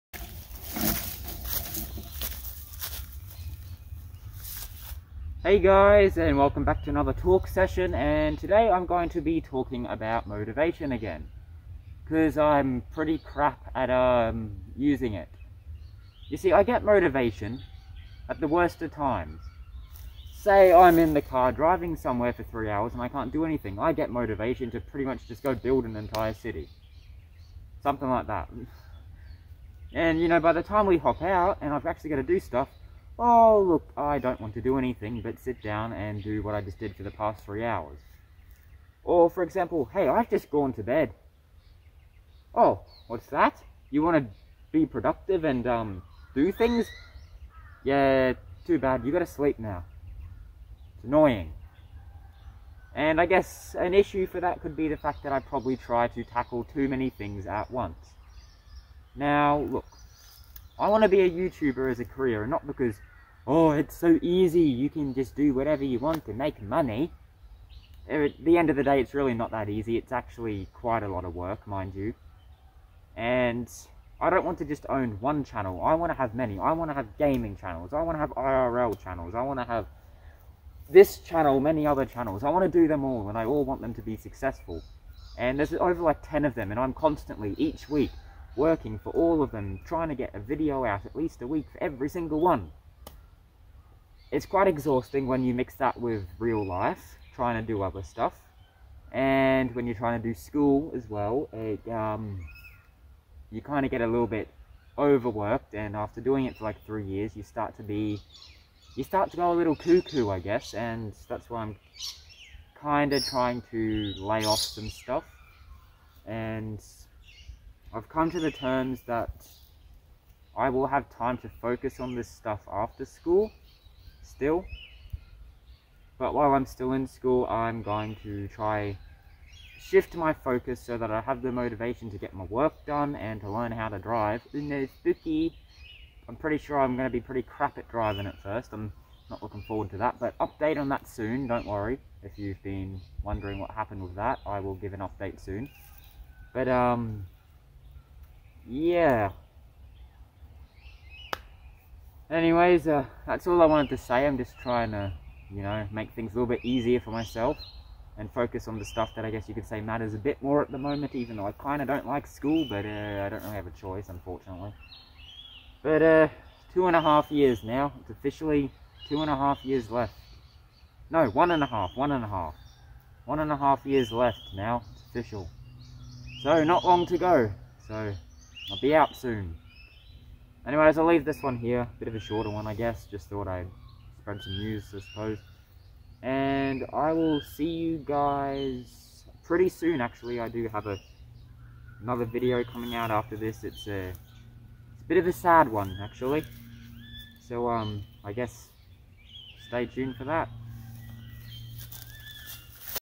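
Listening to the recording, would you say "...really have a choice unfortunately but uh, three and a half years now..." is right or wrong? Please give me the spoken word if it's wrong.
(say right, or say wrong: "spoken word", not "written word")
wrong: "two", not "three".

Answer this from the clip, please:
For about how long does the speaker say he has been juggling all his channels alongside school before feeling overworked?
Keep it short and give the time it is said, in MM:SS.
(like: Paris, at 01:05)
3 years, at 01:46.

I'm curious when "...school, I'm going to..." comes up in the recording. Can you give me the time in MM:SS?
02:07.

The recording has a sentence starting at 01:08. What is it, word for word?
Uh, at the end of the day, it's really not that easy.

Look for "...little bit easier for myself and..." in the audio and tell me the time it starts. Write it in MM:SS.
02:36.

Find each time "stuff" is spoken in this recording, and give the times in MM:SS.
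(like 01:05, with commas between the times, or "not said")
00:32, 01:38, 01:54, 02:02, 02:38.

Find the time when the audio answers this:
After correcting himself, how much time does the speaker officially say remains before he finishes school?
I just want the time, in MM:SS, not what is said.
02:53.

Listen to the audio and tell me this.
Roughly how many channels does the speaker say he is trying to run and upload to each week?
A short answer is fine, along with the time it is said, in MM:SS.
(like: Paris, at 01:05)
10, at 01:26.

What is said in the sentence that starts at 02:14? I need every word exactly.
In the spooky, I'm pretty sure I'm going to be pretty crap at driving at first.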